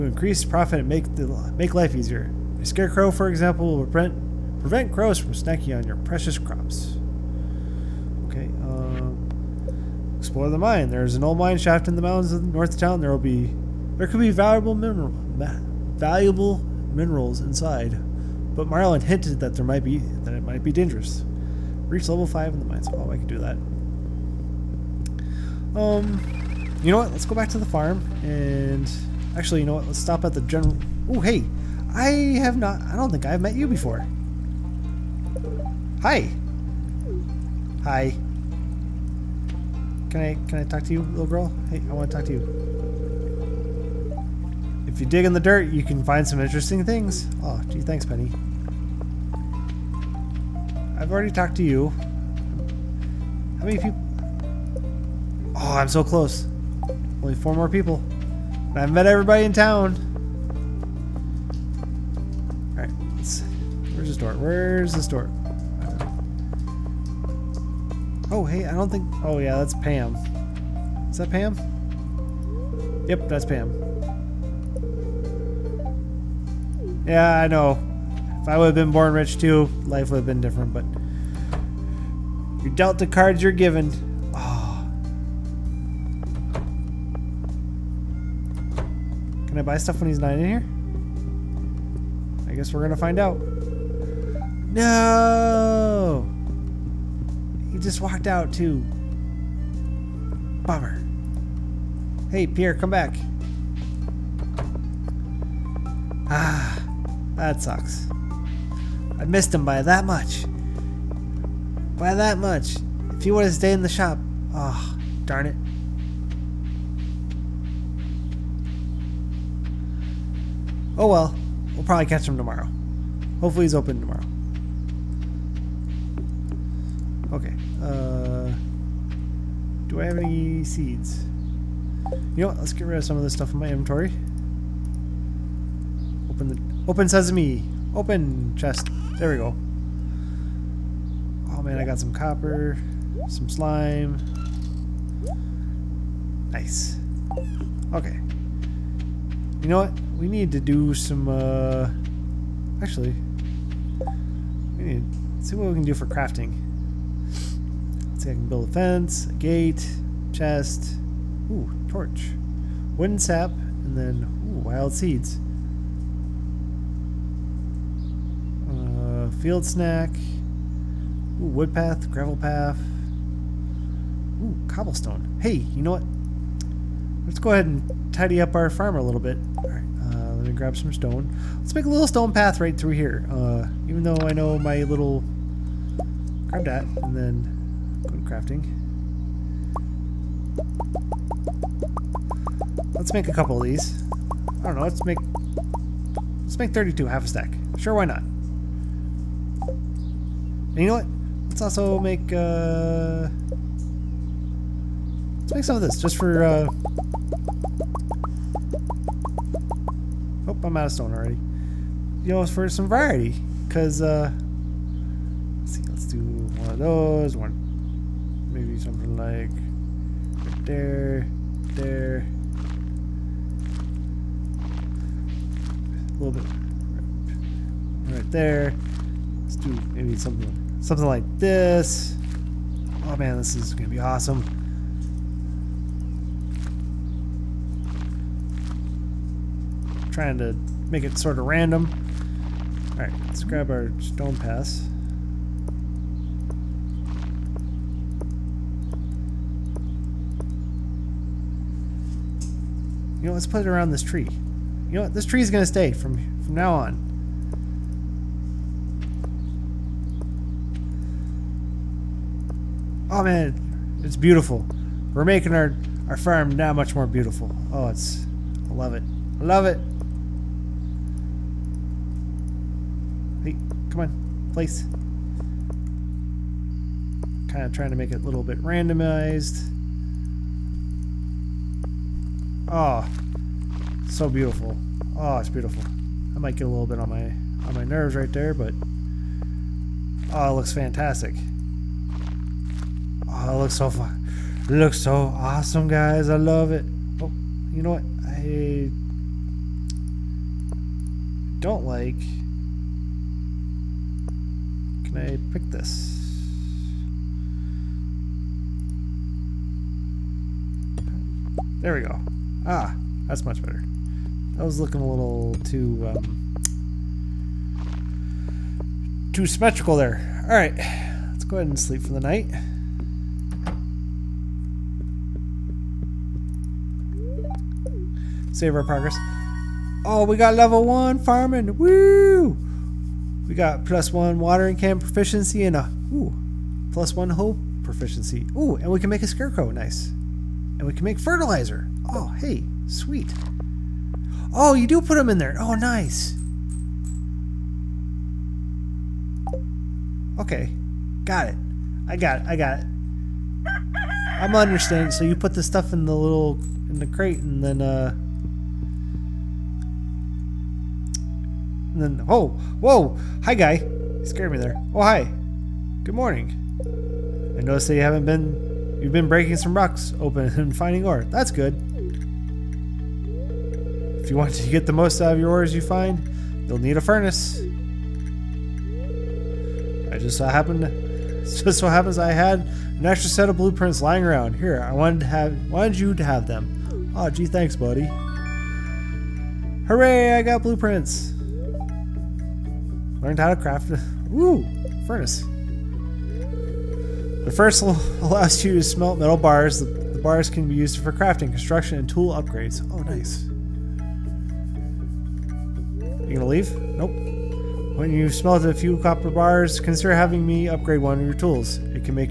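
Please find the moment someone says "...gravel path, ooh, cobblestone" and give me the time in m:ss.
2:52.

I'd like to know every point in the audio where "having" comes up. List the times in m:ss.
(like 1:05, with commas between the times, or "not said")
6:50.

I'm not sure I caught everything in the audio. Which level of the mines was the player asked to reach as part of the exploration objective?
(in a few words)
5.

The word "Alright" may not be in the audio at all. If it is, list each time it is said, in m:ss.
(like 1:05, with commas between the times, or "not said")
2:59, 4:02.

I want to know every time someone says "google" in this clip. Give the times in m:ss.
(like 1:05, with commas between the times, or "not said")
not said.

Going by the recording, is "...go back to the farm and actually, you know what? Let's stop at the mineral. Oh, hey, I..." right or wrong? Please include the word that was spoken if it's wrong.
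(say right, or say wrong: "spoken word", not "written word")
wrong: "general", not "mineral".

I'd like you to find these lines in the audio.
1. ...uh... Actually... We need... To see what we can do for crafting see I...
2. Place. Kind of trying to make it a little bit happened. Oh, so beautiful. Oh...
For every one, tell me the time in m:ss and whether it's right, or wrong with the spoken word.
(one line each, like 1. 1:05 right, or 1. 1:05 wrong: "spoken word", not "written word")
1. 2:31 right
2. 4:34 wrong: "randomized", not "happened".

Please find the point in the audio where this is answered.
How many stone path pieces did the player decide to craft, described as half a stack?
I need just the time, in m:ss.
3:16.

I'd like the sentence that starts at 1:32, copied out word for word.
I guess we're going to find out.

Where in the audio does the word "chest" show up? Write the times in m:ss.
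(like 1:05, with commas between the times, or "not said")
2:18, 2:40.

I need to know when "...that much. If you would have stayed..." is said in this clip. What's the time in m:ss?
1:52.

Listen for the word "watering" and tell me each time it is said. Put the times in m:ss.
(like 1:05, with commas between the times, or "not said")
5:34.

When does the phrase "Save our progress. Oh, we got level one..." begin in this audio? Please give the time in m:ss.
5:28.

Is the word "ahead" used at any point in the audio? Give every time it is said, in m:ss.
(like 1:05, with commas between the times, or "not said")
2:57, 5:21.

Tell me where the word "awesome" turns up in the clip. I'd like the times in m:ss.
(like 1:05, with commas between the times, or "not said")
3:53, 4:55.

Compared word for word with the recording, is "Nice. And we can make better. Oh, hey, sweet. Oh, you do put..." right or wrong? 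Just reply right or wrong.
wrong.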